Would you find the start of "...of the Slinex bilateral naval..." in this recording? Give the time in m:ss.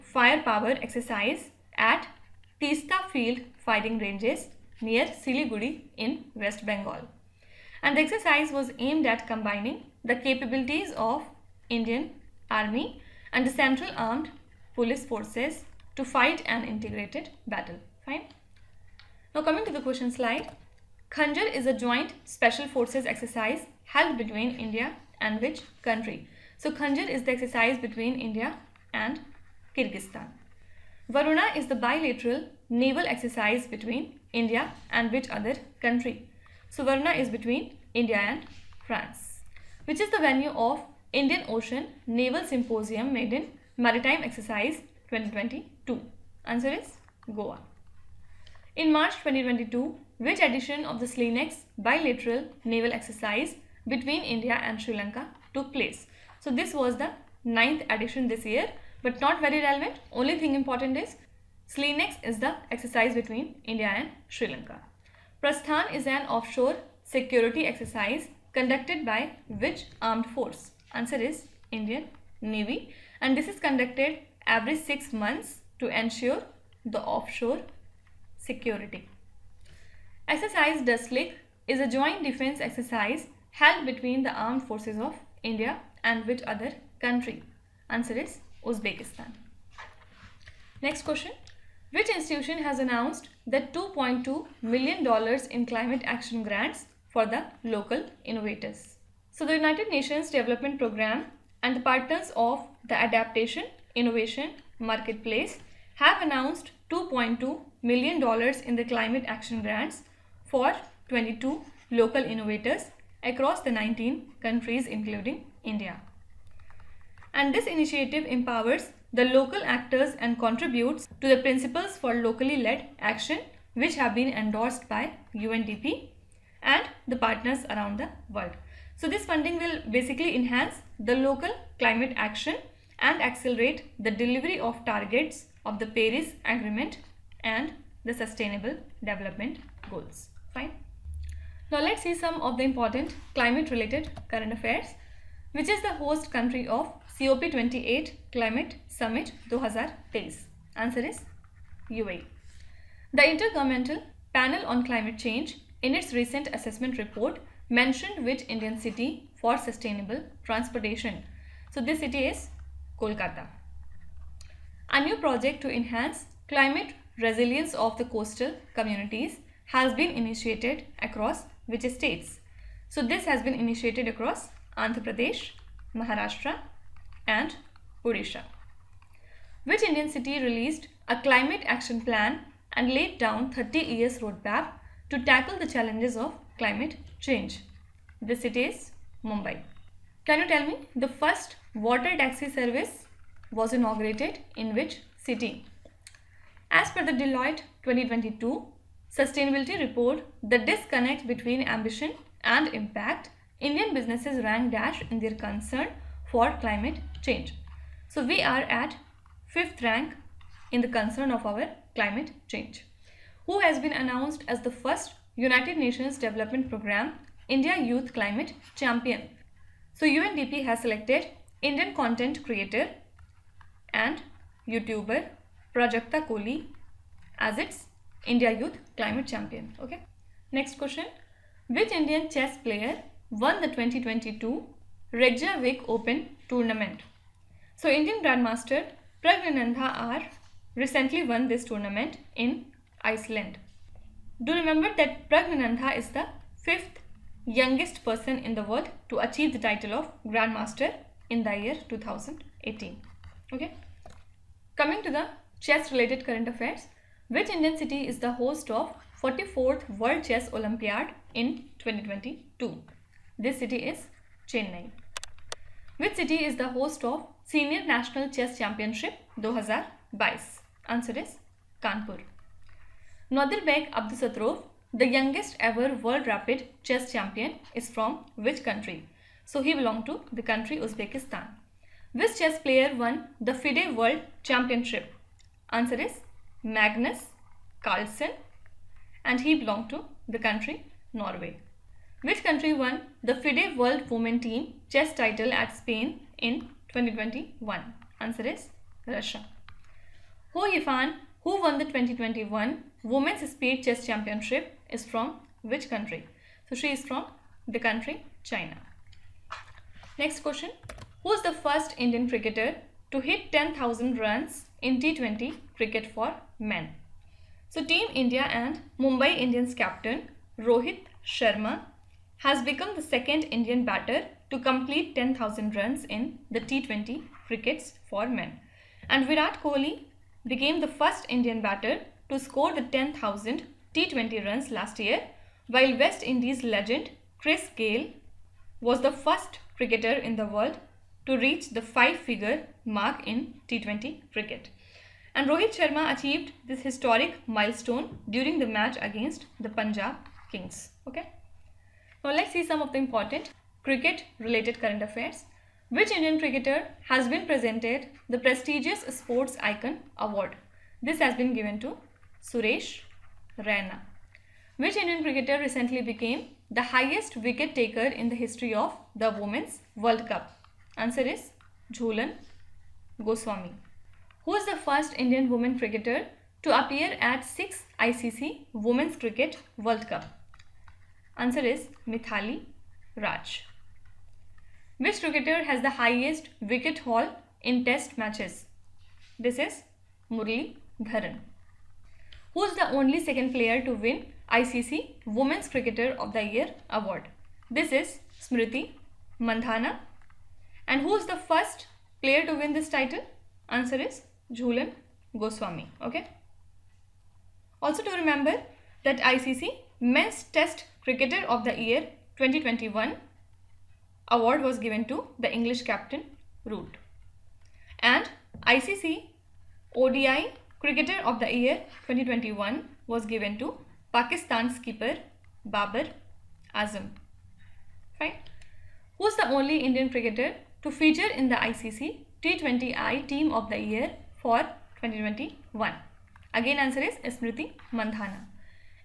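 0:50.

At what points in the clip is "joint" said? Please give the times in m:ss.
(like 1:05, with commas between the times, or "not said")
0:21, 1:21.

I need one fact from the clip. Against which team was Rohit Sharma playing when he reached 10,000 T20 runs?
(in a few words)
Punjab Kings.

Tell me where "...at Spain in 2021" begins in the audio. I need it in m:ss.
4:55.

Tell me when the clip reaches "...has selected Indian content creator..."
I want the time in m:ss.
3:40.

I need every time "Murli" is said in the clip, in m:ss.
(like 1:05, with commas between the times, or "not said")
6:30.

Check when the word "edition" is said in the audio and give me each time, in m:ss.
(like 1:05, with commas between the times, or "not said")
0:50, 0:57.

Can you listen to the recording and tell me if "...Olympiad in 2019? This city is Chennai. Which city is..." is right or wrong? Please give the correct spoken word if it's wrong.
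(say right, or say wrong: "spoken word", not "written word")
wrong: "2022", not "2019".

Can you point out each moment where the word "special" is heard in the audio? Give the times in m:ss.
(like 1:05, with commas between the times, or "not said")
0:22.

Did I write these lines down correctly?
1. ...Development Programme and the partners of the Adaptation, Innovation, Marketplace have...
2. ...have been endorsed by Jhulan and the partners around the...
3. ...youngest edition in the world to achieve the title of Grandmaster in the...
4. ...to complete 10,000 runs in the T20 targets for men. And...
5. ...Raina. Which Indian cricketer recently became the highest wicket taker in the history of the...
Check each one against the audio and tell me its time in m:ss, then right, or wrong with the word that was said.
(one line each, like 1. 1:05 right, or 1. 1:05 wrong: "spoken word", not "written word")
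1. 1:40 right
2. 2:03 wrong: "UNDP", not "Jhulan"
3. 4:07 wrong: "person", not "edition"
4. 5:24 wrong: "crickets", not "targets"
5. 6:03 right.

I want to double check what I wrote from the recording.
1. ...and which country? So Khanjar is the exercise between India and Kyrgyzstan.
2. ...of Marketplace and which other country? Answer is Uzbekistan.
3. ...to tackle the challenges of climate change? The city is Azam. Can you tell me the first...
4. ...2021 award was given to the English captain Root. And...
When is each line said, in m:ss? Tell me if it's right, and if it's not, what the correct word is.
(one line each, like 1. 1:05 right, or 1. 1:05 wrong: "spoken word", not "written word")
1. 0:25 right
2. 1:24 wrong: "India", not "Marketplace"
3. 3:05 wrong: "Mumbai", not "Azam"
4. 6:52 right.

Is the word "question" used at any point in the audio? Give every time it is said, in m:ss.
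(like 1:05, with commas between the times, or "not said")
0:19, 1:31, 3:50, 5:10.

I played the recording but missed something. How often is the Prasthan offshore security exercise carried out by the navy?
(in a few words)
Every 6 months.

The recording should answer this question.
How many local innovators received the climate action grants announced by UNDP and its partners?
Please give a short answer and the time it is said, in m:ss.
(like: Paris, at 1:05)
22, at 1:51.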